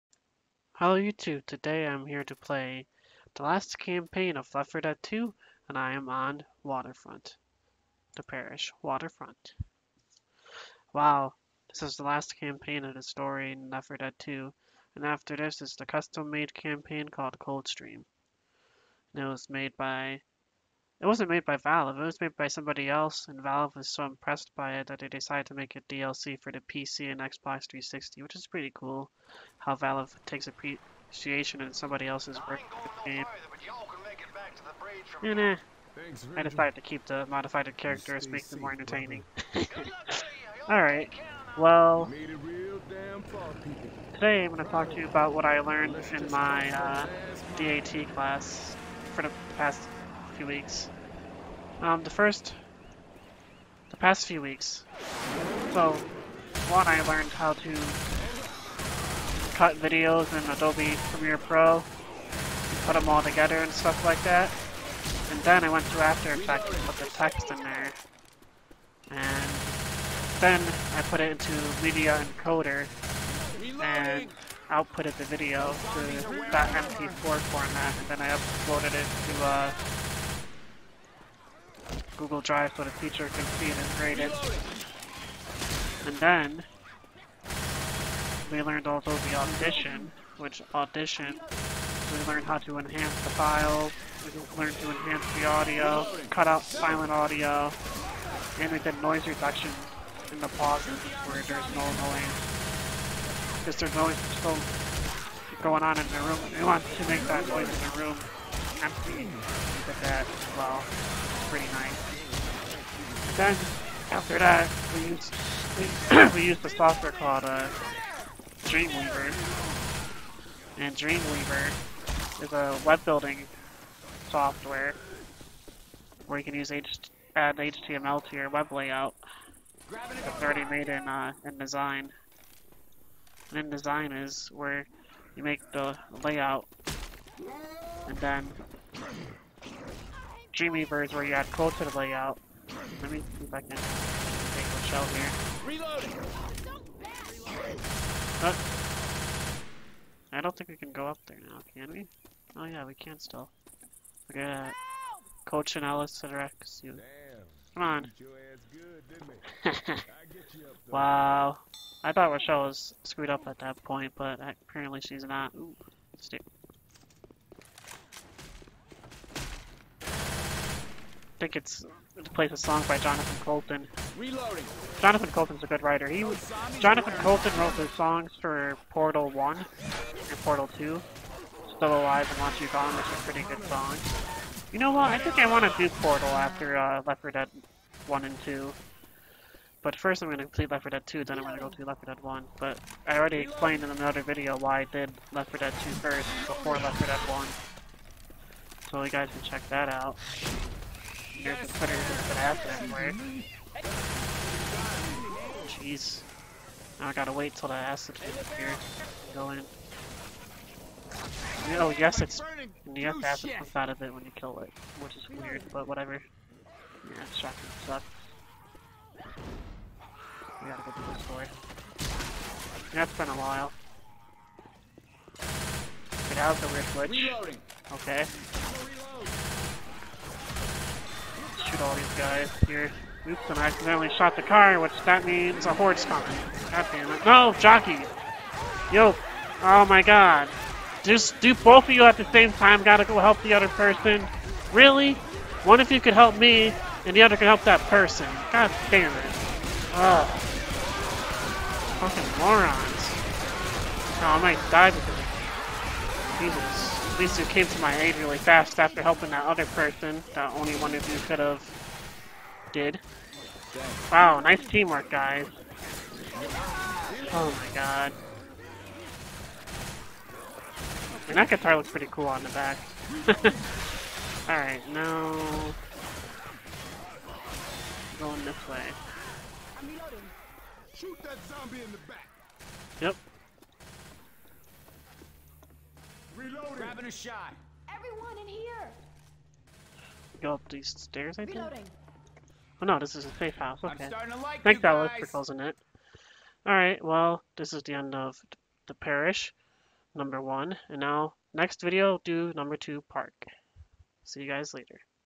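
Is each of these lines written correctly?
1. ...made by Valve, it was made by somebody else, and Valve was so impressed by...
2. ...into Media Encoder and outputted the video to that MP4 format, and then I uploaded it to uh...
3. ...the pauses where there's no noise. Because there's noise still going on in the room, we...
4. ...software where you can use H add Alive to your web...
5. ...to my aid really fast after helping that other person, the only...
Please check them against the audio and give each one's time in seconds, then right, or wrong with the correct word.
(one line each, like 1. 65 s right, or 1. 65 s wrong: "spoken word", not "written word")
1. 21 s right
2. 71 s right
3. 100 s right
4. 124 s wrong: "HTML", not "Alive"
5. 257 s right.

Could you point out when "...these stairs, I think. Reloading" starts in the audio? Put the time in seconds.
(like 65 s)
290 s.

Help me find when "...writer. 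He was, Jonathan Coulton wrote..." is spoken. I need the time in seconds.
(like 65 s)
175 s.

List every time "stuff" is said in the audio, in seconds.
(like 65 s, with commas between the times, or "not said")
63 s, 217 s.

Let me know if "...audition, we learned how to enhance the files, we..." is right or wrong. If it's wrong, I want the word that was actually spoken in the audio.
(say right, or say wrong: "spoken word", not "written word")
right.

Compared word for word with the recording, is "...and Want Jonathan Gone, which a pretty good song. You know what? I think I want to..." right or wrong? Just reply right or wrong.
wrong.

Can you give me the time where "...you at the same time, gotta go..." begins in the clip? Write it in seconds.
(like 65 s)
241 s.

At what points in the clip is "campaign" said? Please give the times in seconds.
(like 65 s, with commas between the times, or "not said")
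3 s, 12 s, 16 s.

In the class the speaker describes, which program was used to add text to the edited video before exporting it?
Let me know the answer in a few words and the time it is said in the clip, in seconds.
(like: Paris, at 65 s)
After Effects, at 66 s.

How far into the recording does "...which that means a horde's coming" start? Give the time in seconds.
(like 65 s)
234 s.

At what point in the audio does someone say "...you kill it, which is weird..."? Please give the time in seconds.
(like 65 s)
214 s.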